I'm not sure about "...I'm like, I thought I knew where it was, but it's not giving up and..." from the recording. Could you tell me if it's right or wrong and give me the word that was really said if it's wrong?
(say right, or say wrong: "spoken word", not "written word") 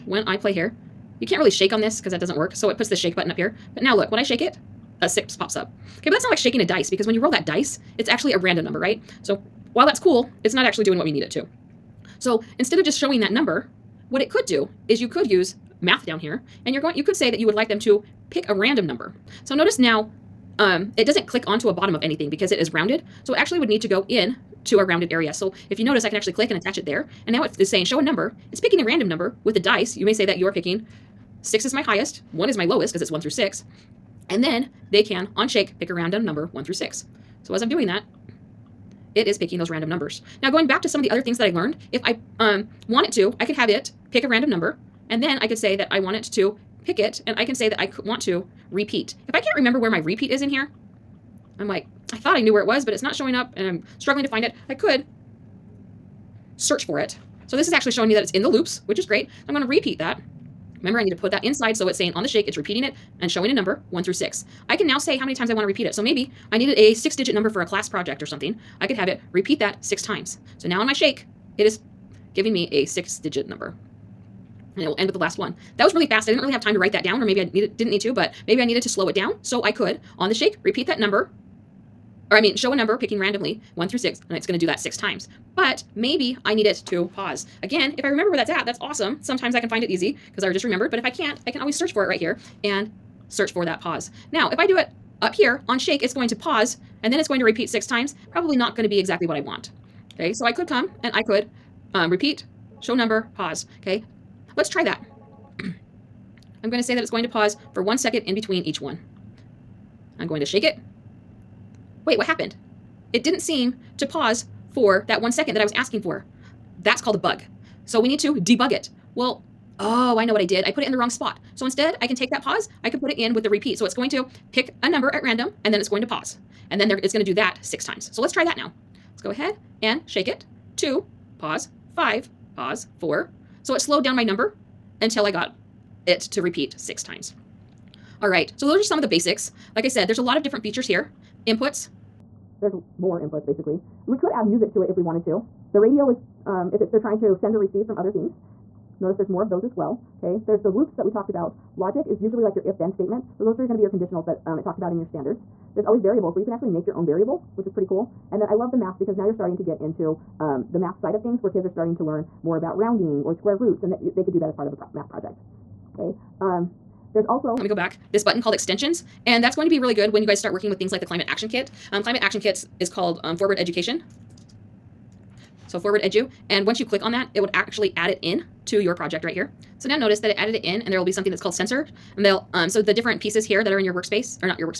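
wrong: "showing", not "giving".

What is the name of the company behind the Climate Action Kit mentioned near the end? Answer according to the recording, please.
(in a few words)
Forward Education.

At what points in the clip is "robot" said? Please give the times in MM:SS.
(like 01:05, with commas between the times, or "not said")
not said.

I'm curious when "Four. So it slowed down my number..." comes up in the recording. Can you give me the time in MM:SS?
02:12.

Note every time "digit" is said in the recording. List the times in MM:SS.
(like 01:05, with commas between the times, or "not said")
01:07, 01:13.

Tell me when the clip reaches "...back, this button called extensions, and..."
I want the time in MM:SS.
02:47.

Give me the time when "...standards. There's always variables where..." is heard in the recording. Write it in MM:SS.
02:35.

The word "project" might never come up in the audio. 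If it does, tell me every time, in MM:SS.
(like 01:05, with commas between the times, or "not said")
01:07, 02:45, 02:58.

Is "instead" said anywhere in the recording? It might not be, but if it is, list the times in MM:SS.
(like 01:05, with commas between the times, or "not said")
00:12, 02:01.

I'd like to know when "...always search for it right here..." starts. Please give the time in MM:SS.
01:31.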